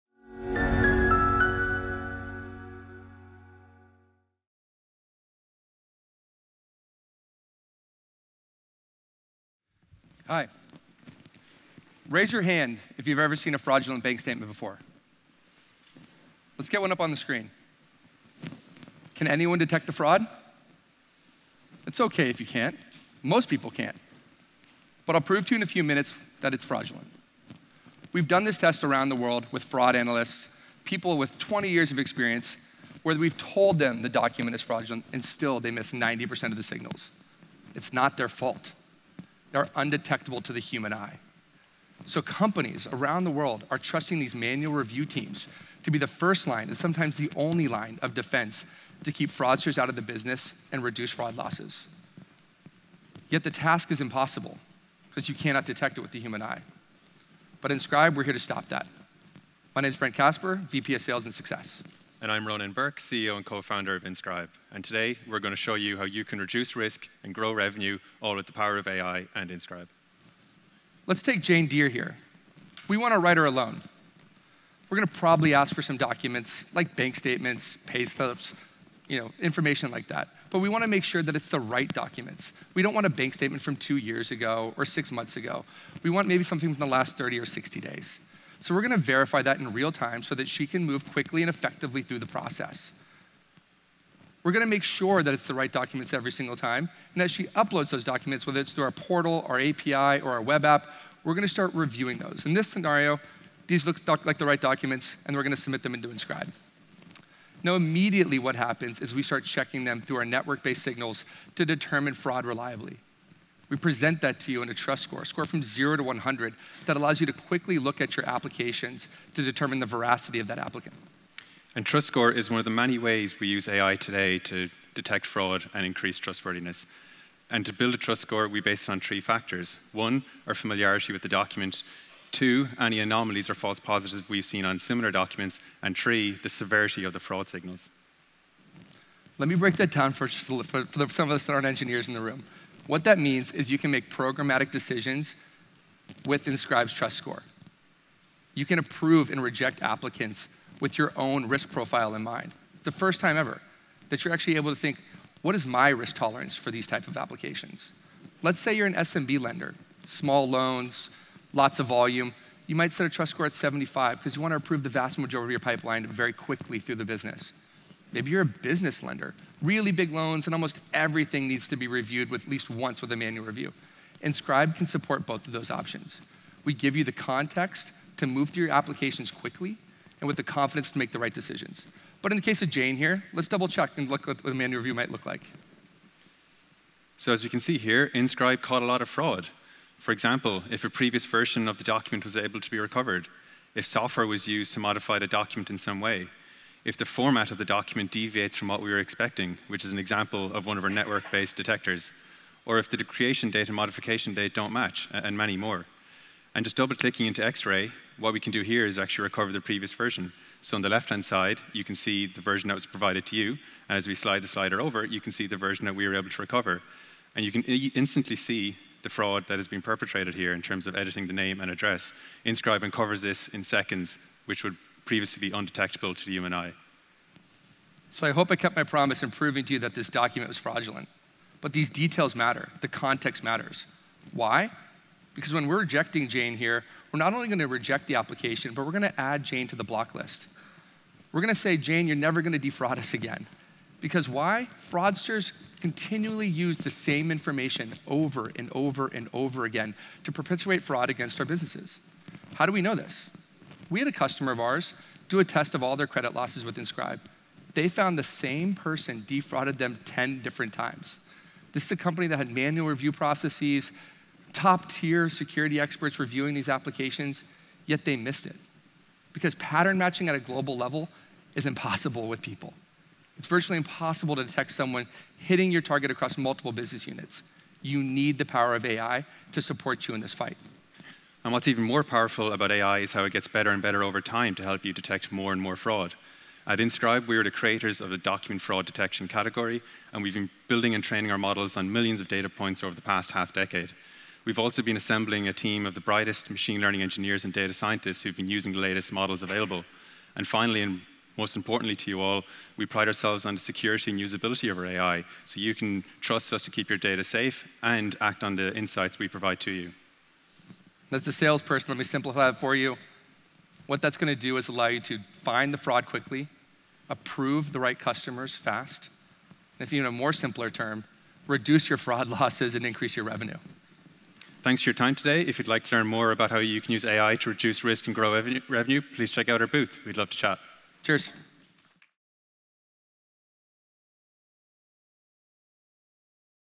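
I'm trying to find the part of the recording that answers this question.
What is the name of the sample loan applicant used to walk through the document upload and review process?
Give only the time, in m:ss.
1:11.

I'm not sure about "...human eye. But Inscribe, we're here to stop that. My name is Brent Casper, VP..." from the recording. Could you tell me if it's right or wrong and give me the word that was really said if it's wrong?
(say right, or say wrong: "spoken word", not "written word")
right.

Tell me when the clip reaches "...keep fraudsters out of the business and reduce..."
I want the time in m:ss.
0:49.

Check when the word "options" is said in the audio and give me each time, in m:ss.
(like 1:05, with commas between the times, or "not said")
2:55.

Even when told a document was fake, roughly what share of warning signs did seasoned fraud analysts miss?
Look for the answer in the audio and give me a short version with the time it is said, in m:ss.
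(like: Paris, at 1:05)
90%, at 0:35.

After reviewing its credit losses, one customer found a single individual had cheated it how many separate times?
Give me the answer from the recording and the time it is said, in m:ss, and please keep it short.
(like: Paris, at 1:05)
10, at 4:20.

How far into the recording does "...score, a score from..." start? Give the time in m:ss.
1:55.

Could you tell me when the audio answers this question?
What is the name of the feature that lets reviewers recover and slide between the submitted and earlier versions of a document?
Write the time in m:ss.
3:27.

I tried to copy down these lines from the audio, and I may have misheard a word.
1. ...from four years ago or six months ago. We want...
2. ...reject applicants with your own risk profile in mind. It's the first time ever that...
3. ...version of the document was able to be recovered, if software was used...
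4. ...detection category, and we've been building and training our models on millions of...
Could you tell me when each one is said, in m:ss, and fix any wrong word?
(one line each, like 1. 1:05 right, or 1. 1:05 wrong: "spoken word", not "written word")
1. 1:23 wrong: "two", not "four"
2. 2:29 right
3. 3:11 right
4. 4:48 right.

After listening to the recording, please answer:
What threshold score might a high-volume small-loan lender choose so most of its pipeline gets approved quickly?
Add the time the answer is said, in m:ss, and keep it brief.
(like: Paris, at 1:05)
75, at 2:43.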